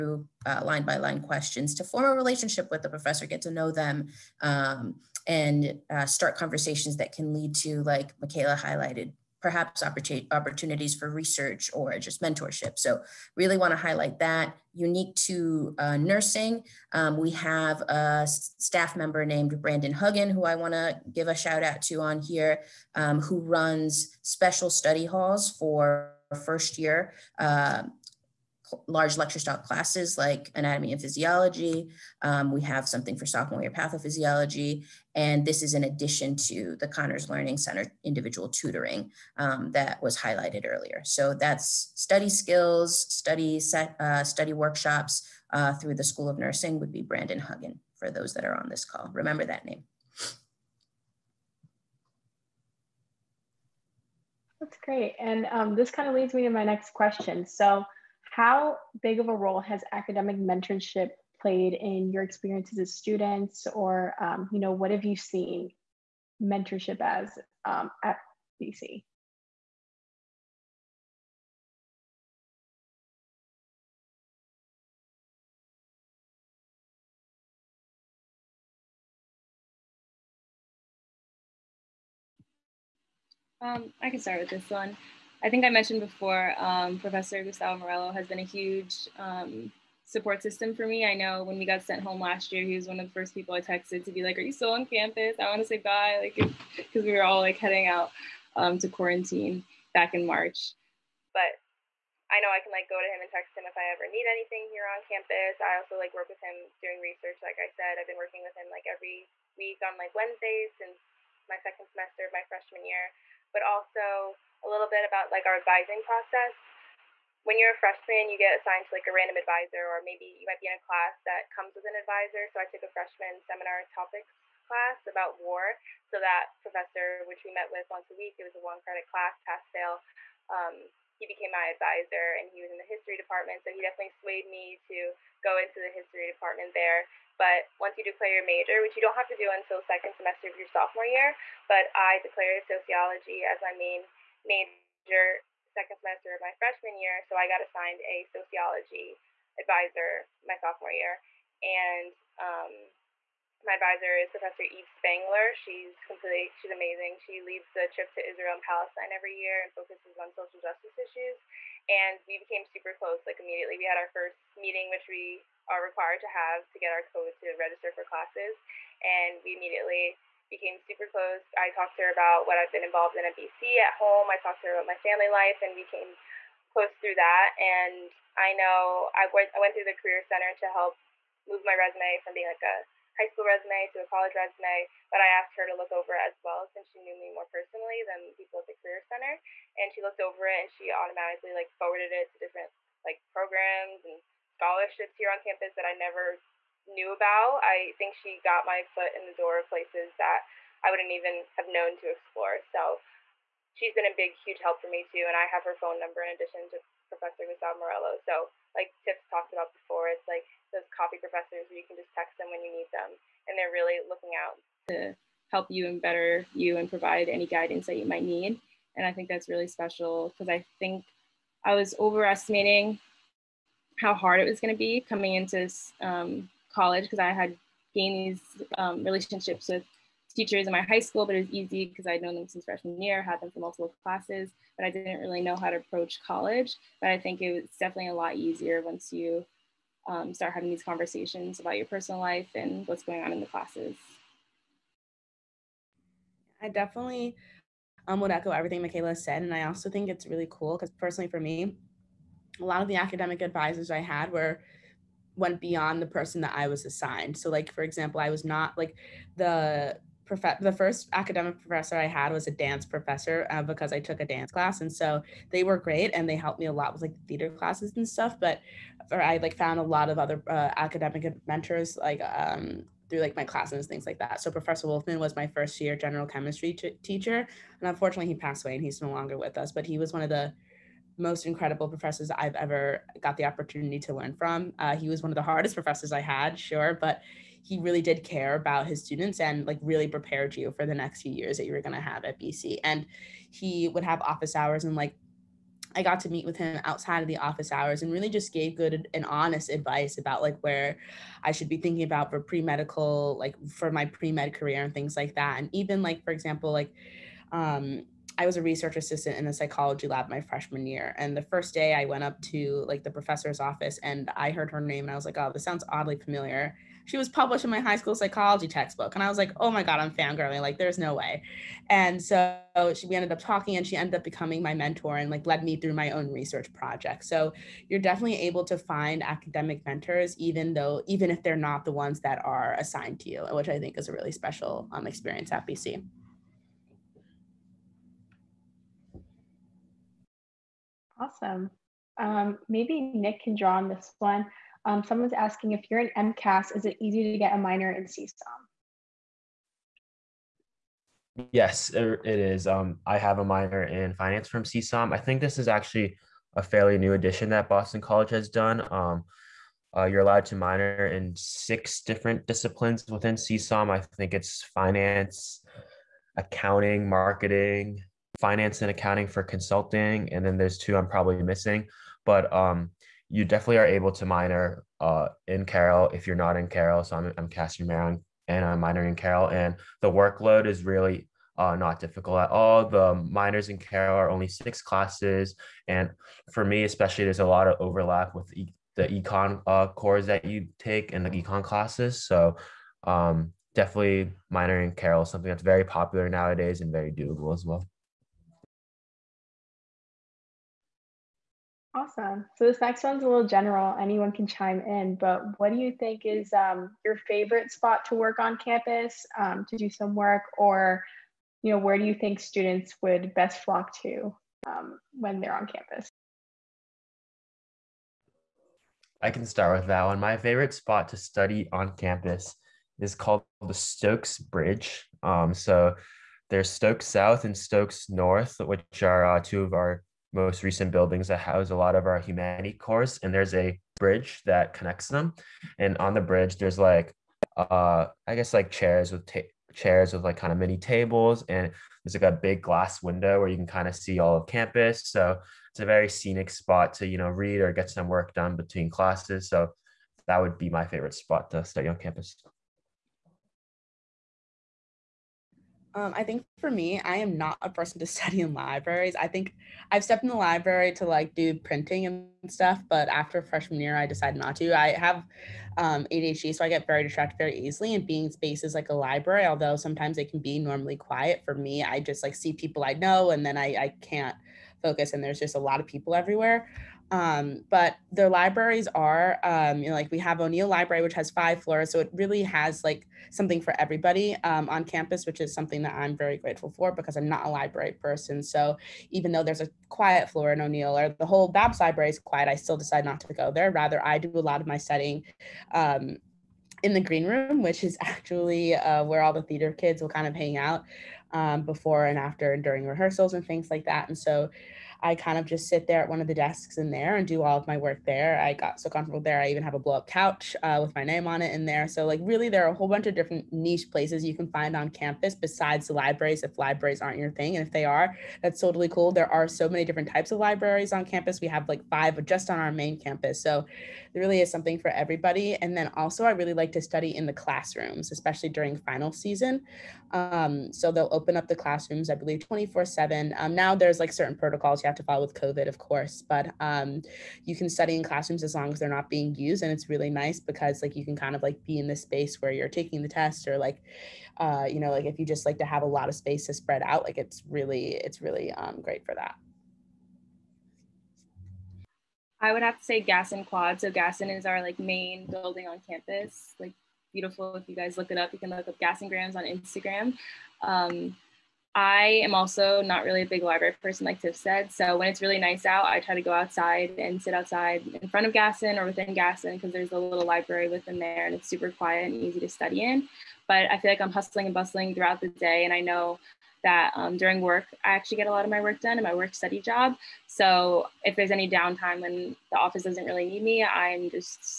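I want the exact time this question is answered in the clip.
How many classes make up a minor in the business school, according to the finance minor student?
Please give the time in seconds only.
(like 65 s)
384 s.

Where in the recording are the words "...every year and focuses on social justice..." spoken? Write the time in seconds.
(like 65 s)
159 s.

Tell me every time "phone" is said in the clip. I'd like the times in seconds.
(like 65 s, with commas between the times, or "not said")
205 s.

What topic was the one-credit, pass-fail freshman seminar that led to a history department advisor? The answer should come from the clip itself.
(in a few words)
war.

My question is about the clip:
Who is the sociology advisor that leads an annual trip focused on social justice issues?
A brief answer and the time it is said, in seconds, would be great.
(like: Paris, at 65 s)
Eve Spangler, at 154 s.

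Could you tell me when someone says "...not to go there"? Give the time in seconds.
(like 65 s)
493 s.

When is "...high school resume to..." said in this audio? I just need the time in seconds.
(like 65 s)
183 s.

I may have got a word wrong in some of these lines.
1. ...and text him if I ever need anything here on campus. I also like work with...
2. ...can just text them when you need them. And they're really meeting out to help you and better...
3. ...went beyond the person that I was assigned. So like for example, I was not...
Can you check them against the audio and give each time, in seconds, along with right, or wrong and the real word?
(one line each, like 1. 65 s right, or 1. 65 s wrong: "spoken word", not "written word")
1. 103 s right
2. 211 s wrong: "looking", not "meeting"
3. 255 s right.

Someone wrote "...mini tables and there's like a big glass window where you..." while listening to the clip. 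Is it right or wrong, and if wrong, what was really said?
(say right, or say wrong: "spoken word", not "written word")
right.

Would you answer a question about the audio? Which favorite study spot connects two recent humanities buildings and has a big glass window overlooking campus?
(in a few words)
Stokes Bridge.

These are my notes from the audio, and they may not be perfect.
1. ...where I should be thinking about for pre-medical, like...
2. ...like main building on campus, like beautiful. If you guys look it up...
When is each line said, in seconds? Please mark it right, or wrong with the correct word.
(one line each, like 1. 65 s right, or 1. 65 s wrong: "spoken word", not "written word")
1. 300 s right
2. 554 s right.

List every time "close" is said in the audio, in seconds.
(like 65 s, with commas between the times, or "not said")
162 s, 171 s, 176 s.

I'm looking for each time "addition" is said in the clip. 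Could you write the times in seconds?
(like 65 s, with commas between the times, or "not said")
35 s, 206 s, 357 s.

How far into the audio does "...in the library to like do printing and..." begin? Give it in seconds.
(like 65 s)
460 s.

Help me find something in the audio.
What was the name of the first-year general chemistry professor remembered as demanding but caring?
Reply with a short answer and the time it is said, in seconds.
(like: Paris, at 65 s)
Professor Wolfman, at 274 s.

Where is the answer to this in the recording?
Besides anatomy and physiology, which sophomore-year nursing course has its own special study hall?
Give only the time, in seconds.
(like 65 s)
33 s.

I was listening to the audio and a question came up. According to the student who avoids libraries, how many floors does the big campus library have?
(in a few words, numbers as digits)
5.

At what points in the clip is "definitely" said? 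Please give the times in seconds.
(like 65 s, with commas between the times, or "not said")
133 s, 237 s, 246 s, 327 s, 373 s, 393 s.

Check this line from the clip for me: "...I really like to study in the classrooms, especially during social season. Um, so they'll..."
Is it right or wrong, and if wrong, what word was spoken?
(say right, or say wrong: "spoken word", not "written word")
wrong: "final", not "social".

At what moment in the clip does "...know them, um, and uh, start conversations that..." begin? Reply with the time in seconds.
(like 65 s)
3 s.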